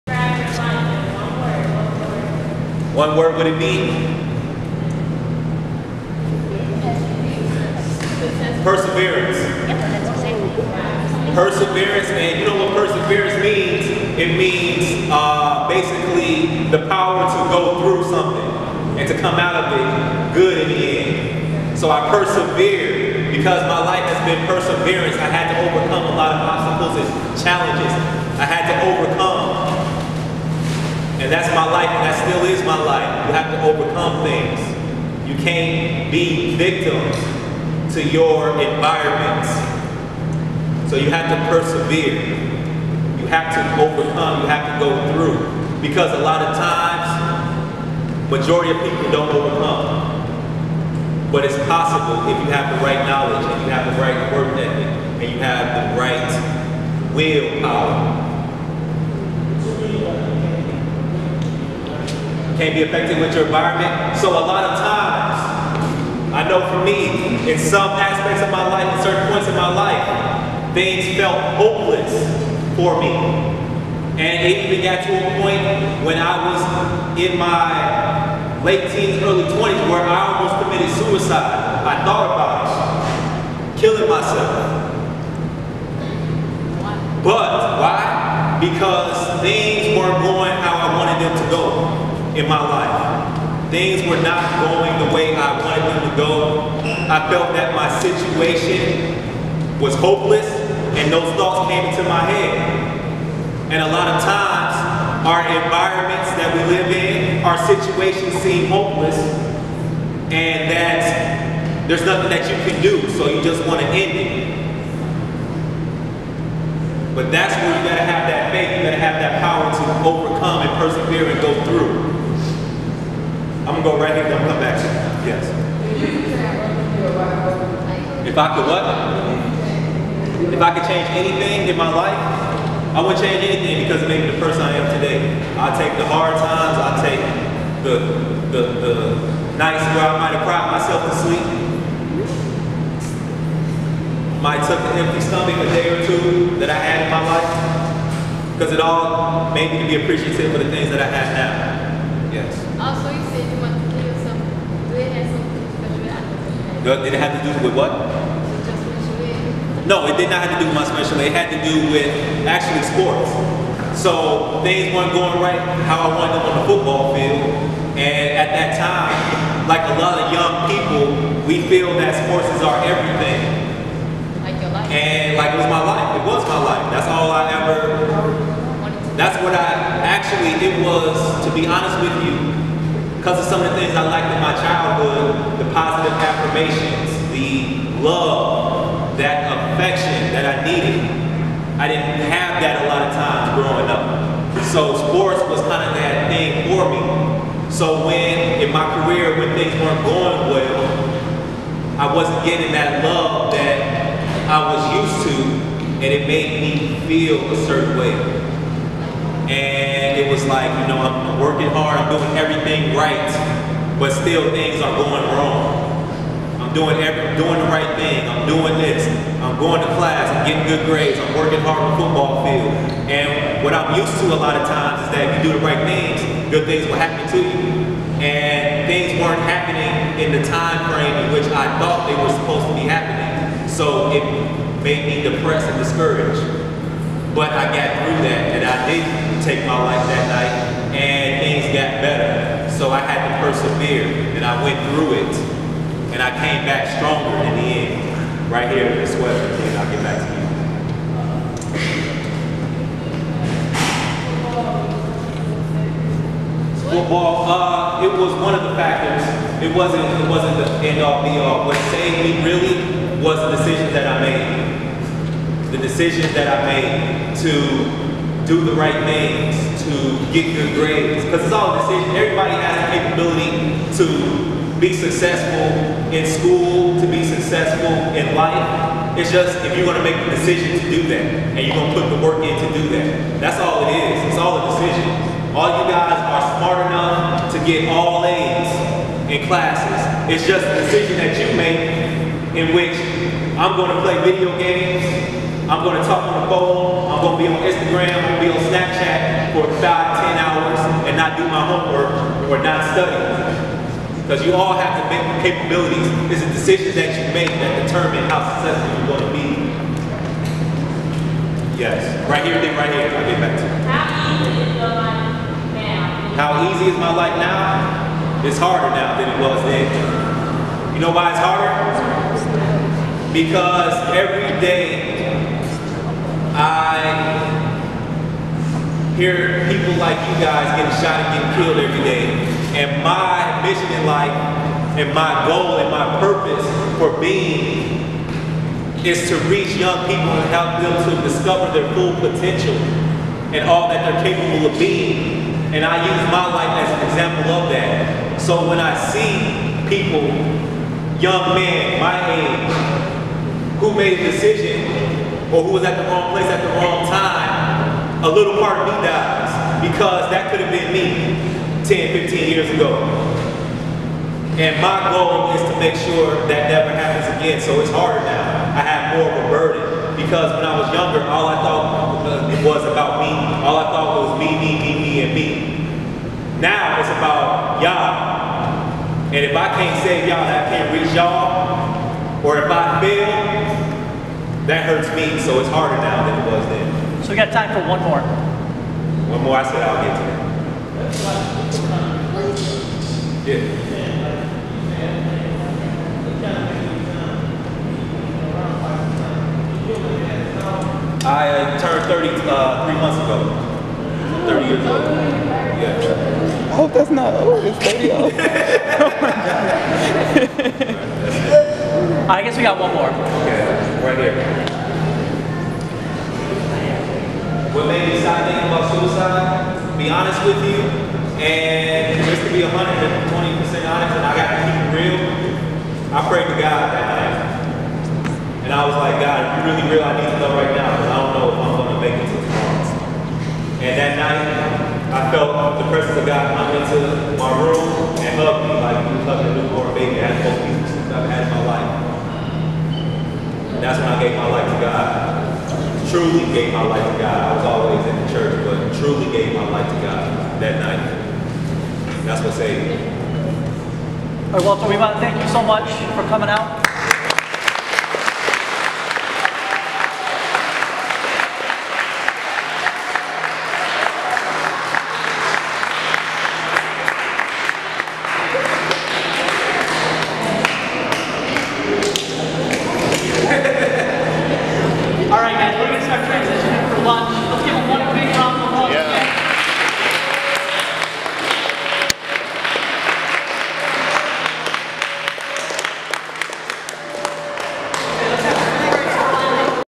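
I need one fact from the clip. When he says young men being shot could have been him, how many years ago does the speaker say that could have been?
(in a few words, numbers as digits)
10 to 15 years.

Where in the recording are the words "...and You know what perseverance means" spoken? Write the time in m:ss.
0:12.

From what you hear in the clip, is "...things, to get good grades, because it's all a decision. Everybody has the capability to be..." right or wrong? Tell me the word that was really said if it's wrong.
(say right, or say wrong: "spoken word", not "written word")
right.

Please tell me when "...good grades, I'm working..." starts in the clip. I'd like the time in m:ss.
3:40.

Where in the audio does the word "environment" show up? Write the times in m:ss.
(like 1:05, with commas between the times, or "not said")
0:38, 1:03, 1:45.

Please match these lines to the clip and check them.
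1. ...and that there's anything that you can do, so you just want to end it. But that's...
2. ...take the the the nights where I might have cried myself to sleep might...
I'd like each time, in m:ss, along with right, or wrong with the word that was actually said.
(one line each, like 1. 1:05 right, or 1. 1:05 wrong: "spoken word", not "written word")
1. 1:50 wrong: "nothing", not "anything"
2. 2:17 right.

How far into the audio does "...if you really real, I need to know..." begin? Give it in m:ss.
7:09.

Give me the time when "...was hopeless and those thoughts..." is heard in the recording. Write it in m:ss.
1:39.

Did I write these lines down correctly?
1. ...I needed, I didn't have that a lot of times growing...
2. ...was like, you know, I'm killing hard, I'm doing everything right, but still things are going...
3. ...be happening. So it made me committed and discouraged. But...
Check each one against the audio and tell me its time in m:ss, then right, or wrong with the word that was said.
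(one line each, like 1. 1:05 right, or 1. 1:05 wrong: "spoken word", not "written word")
1. 3:10 right
2. 3:30 wrong: "working", not "killing"
3. 3:52 wrong: "depressed", not "committed".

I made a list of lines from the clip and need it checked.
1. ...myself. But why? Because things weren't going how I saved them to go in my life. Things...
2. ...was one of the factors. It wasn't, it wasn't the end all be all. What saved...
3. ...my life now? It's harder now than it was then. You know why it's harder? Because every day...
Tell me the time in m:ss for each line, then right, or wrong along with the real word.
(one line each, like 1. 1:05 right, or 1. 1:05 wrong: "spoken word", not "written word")
1. 1:24 wrong: "wanted", not "saved"
2. 4:18 right
3. 5:16 right.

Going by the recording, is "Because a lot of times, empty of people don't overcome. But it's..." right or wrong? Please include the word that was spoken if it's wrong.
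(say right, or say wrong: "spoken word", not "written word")
wrong: "majority", not "empty".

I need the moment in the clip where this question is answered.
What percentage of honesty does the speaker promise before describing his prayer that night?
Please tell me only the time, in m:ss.
7:02.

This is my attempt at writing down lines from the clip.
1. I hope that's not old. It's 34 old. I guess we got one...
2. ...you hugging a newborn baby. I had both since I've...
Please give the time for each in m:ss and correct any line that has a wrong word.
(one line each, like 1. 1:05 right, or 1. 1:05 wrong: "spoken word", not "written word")
1. 6:46 wrong: "30", not "34"
2. 7:19 right.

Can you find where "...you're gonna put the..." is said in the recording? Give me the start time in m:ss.
4:41.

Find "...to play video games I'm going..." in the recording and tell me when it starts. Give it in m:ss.
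4:53.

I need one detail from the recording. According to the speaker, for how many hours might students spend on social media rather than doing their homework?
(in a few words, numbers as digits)
5 to 10 hours.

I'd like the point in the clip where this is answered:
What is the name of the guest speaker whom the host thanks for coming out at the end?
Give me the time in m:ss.
7:34.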